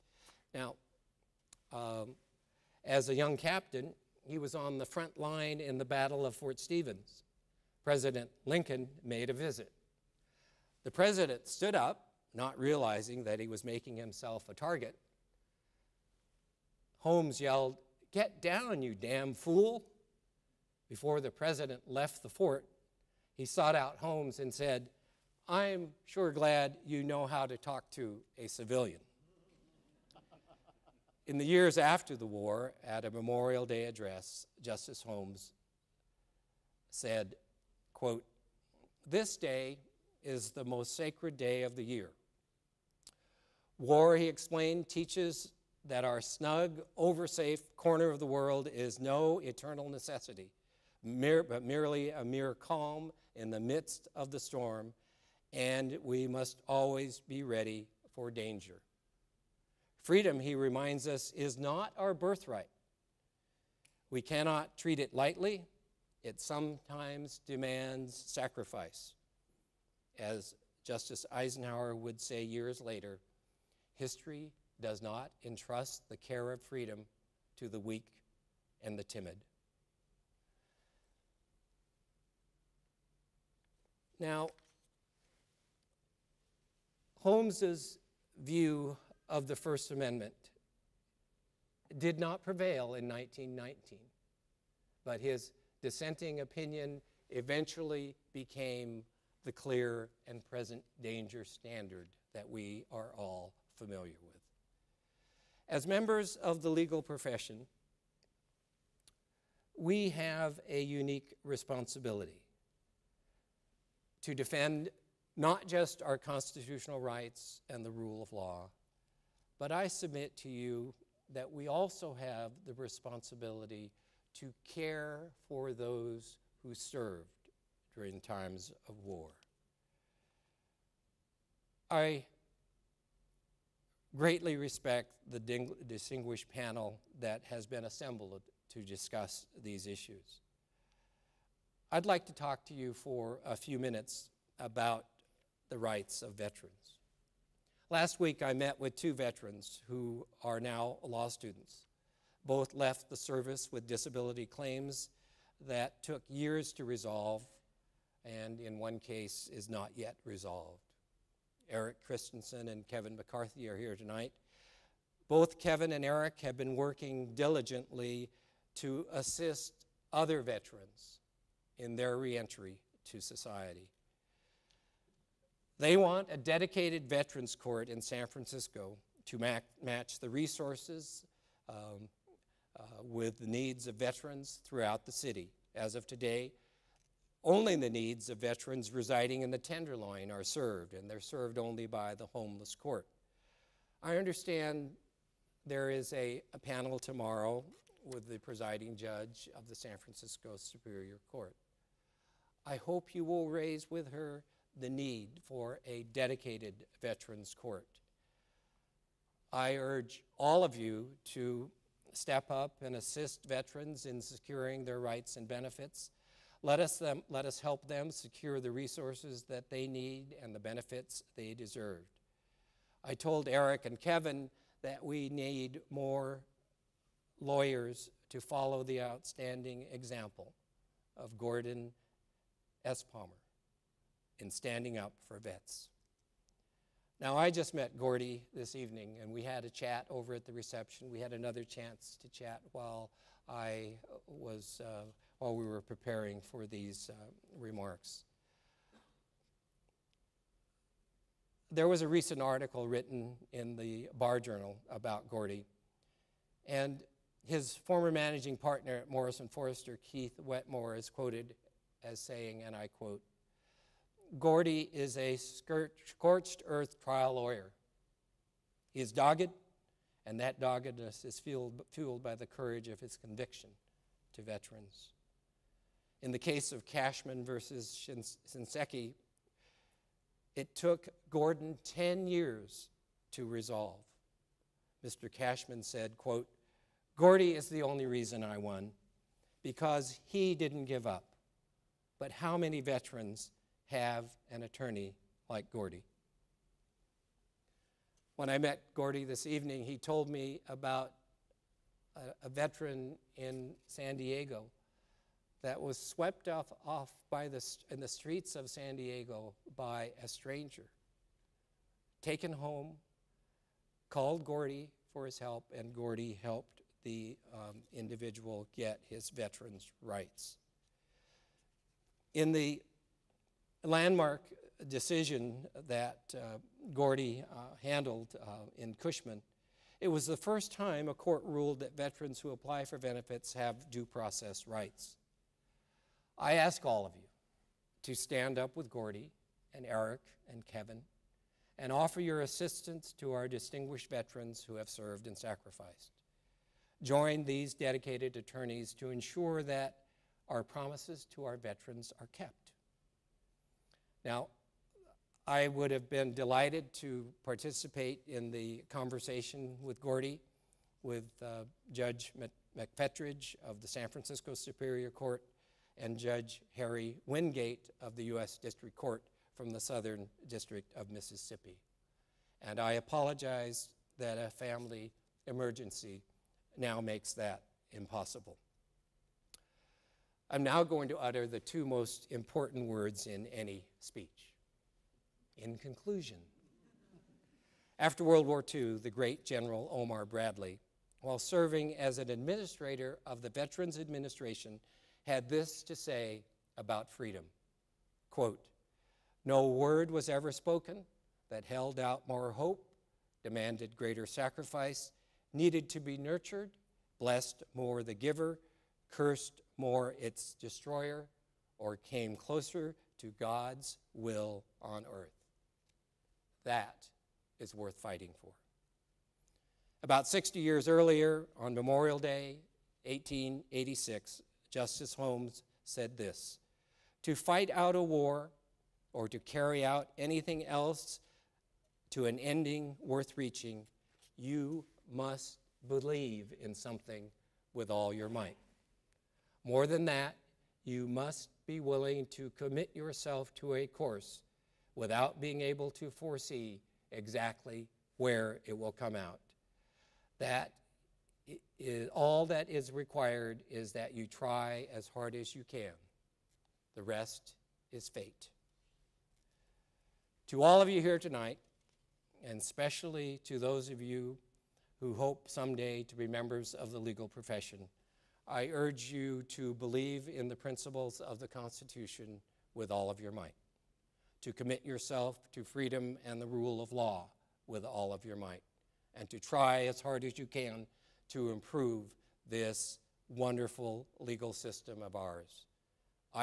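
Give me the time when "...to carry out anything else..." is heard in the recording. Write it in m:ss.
7:09.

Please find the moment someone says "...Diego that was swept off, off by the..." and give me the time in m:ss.
5:04.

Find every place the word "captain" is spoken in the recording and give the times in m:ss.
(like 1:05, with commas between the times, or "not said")
0:03.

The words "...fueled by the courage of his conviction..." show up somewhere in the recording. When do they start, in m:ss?
4:31.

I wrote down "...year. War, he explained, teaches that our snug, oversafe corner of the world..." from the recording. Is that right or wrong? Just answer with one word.
right.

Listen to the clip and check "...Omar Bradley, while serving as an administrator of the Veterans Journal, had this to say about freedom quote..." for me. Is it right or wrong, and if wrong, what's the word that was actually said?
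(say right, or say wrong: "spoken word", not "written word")
wrong: "Administration", not "Journal".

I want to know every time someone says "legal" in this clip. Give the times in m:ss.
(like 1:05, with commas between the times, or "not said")
1:46, 7:46, 8:04.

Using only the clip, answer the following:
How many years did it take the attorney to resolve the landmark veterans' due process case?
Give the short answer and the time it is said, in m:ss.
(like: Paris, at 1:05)
10, at 4:41.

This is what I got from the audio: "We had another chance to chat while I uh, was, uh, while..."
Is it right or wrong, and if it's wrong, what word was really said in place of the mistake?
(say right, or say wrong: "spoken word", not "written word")
right.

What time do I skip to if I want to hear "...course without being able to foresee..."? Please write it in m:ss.
7:23.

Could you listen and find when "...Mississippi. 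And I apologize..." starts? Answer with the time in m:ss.
6:11.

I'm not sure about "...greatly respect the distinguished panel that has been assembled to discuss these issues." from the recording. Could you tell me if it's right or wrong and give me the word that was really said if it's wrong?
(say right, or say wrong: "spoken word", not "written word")
right.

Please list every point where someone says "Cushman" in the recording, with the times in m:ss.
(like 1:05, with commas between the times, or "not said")
4:36, 4:45, 5:28.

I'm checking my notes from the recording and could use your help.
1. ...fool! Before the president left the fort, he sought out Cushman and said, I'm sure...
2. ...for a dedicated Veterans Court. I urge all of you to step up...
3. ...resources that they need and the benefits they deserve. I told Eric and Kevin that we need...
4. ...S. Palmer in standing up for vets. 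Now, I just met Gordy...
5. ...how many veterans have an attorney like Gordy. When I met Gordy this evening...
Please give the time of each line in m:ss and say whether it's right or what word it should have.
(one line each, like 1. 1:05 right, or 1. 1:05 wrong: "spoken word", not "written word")
1. 0:19 wrong: "Holmes", not "Cushman"
2. 3:25 right
3. 3:38 right
4. 3:52 right
5. 4:52 right.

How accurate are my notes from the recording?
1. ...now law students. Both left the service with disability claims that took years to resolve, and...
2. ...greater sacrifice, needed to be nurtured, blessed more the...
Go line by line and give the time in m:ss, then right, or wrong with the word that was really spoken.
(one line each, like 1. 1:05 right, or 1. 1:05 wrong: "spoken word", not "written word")
1. 2:30 right
2. 6:43 right.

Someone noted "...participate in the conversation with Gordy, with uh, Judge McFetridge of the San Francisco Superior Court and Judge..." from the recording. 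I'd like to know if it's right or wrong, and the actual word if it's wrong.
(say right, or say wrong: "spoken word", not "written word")
right.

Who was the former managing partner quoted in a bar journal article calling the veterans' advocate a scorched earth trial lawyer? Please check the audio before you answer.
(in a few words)
Keith Wetmore.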